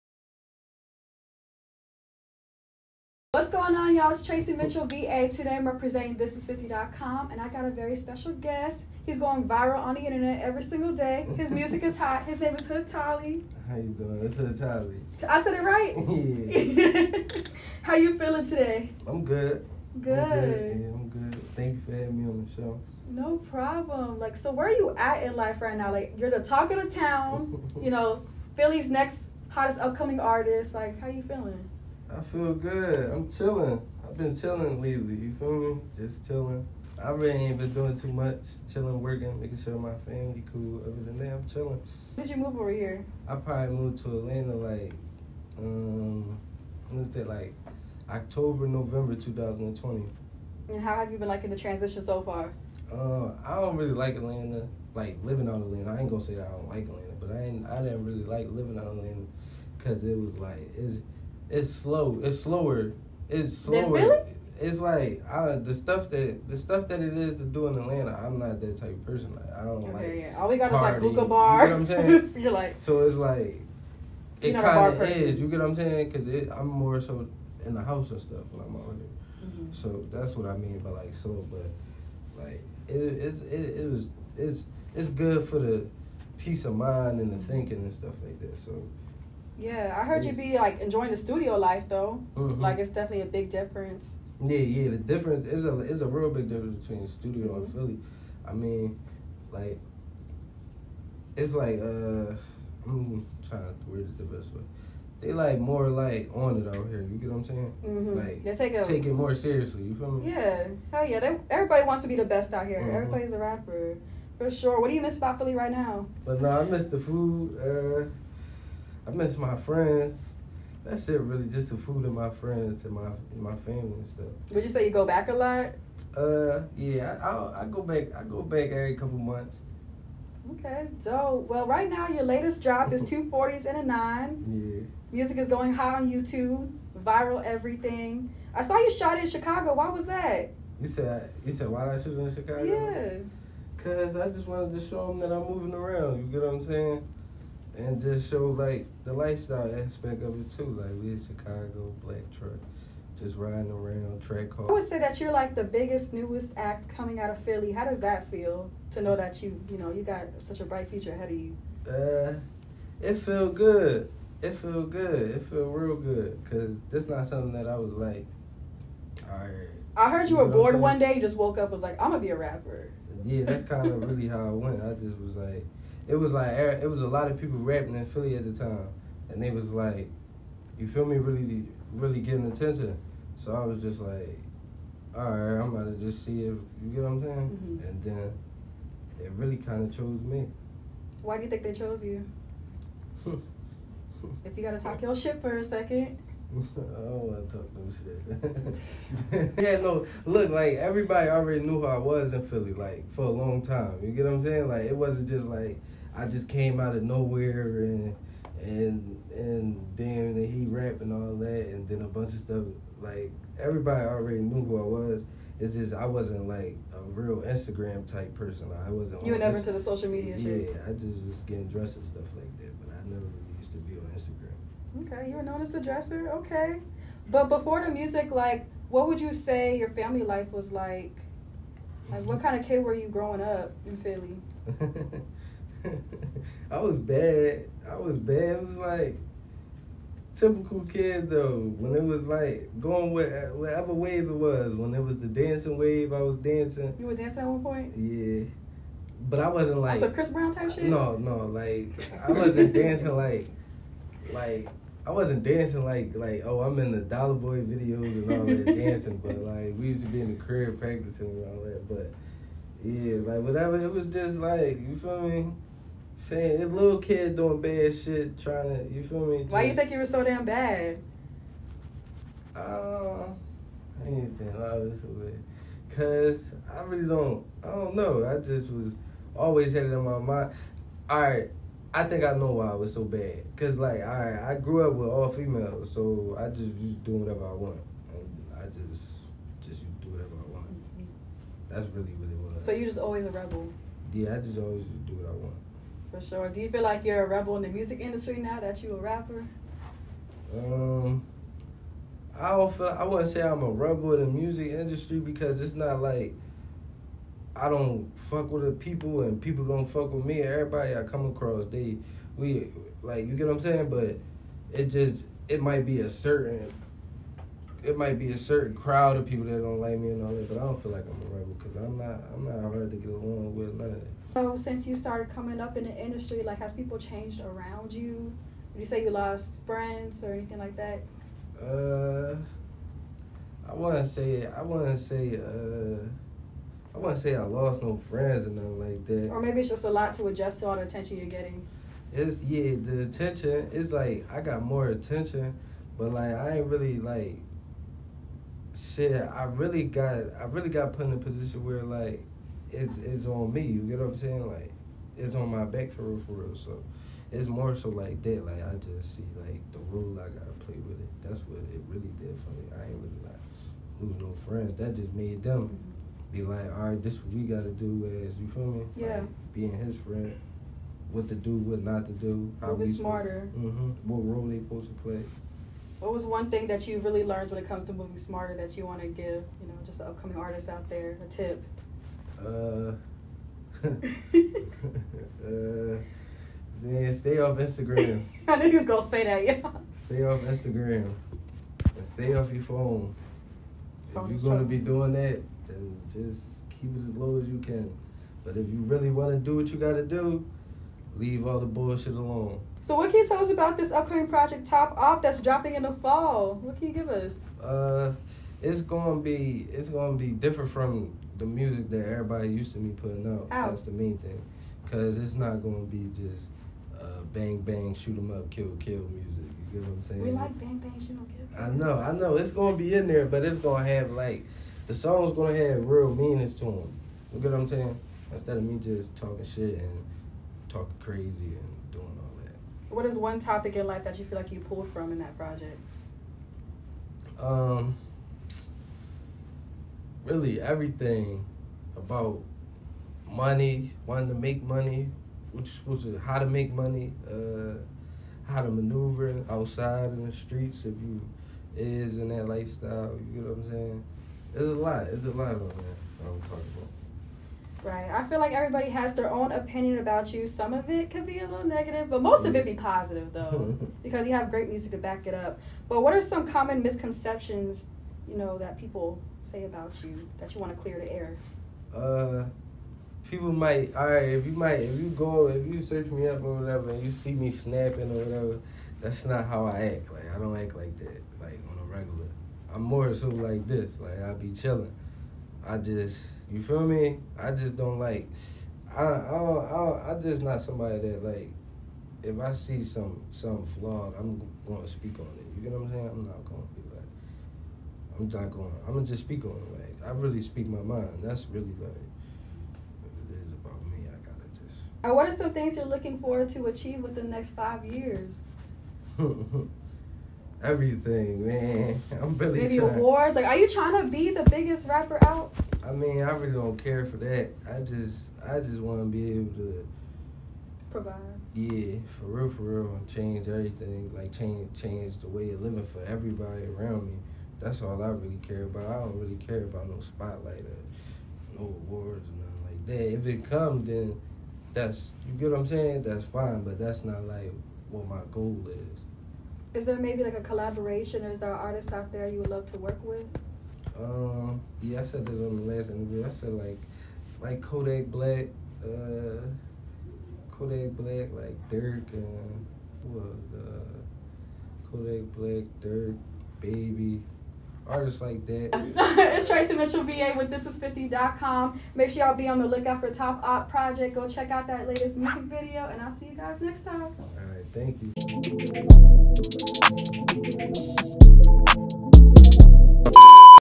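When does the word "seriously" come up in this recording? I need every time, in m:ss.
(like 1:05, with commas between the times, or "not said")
1:49.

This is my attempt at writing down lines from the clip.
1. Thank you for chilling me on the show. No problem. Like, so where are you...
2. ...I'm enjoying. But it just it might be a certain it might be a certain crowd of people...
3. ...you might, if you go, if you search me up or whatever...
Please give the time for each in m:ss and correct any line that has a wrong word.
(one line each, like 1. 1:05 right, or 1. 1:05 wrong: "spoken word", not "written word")
1. 0:21 wrong: "having", not "chilling"
2. 5:13 wrong: "saying", not "enjoying"
3. 7:54 right.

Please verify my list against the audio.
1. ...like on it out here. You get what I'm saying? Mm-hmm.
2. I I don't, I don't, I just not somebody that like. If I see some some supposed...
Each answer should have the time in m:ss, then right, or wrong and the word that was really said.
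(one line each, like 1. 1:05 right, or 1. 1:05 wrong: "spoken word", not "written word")
1. 1:45 right
2. 8:08 wrong: "flawed", not "supposed".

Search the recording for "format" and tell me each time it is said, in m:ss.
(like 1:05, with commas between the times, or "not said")
not said.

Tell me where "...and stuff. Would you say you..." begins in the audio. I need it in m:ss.
2:03.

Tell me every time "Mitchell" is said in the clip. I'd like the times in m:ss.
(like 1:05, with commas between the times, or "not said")
0:04, 9:19.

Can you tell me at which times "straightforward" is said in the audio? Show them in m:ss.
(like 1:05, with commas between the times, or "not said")
not said.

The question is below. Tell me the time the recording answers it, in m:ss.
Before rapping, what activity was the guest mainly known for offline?
3:41.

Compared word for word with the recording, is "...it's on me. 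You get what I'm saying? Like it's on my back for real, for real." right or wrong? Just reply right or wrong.
right.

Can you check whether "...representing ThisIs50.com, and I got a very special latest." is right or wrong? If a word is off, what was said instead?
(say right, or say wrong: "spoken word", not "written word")
wrong: "guest", not "latest".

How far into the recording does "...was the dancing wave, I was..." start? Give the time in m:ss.
4:05.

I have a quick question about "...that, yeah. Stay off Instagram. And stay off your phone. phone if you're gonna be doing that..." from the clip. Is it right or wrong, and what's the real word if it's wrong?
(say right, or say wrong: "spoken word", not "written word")
right.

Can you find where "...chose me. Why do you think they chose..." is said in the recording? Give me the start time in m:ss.
3:09.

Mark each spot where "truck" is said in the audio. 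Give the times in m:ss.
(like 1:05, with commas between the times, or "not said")
2:32.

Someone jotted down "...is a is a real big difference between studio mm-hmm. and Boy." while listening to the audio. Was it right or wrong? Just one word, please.
wrong.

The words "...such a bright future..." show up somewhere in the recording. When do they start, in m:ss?
2:40.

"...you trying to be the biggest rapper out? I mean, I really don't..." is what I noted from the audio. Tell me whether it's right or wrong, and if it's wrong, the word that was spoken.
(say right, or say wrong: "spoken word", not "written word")
right.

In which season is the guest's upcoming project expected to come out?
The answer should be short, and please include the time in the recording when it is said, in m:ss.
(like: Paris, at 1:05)
Fall, at 6:45.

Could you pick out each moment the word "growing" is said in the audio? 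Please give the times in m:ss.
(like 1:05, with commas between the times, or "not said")
3:53.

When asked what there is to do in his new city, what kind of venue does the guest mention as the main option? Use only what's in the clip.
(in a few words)
Hookah bar.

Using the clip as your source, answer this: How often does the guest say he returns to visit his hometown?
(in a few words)
Every couple months.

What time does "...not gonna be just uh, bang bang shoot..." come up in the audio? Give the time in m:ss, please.
6:55.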